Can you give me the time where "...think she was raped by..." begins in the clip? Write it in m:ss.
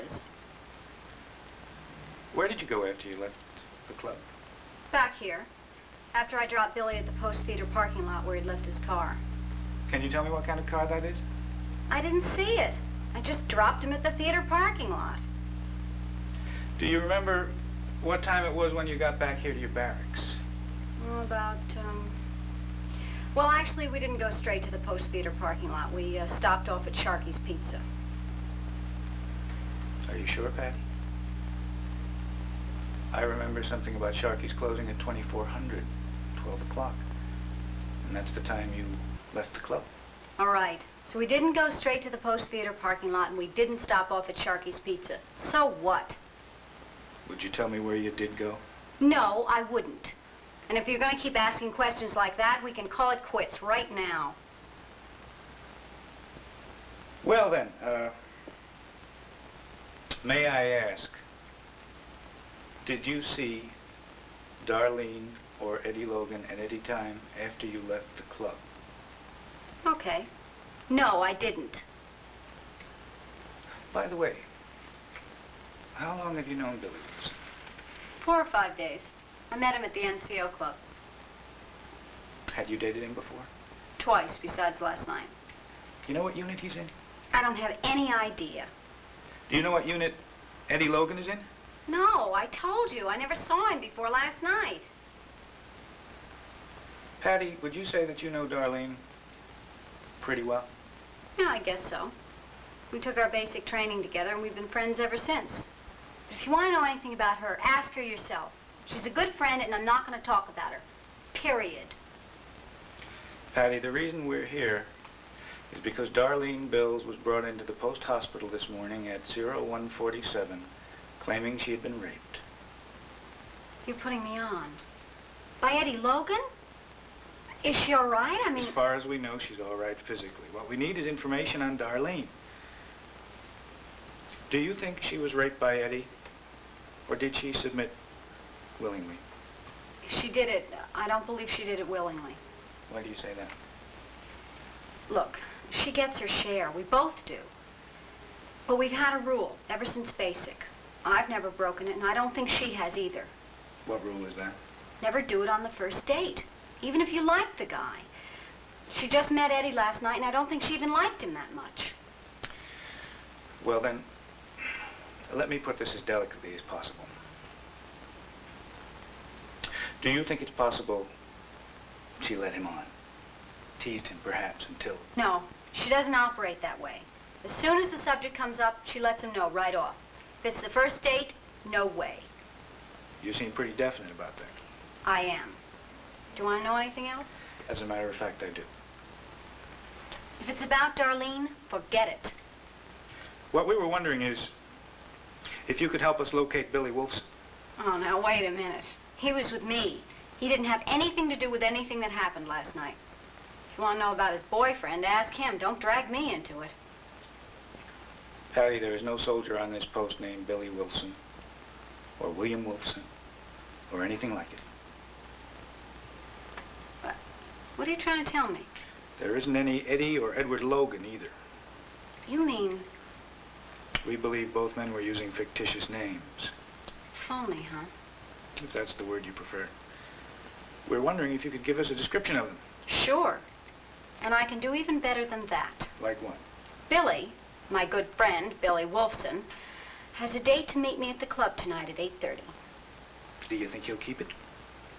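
2:14.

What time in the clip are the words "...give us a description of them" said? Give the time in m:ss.
3:51.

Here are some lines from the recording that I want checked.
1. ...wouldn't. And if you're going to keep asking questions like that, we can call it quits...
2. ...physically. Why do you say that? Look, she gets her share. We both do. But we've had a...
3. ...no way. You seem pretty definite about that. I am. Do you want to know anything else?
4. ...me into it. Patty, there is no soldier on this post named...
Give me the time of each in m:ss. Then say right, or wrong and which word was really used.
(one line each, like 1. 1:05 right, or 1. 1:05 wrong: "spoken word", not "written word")
1. 0:49 right
2. 2:21 wrong: "willingly", not "physically"
3. 3:01 right
4. 3:26 right.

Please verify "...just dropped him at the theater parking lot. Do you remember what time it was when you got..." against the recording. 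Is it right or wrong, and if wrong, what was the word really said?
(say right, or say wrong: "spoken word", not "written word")
right.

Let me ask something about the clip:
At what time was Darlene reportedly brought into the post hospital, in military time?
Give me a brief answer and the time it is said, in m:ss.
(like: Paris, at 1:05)
0147, at 1:59.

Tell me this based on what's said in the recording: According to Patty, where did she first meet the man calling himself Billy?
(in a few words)
The NCO club.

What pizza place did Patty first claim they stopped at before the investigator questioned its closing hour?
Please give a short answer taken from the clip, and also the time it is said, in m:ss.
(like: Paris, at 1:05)
Sharky's Pizza, at 0:26.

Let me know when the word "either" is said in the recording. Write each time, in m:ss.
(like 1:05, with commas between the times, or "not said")
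2:32, 3:41.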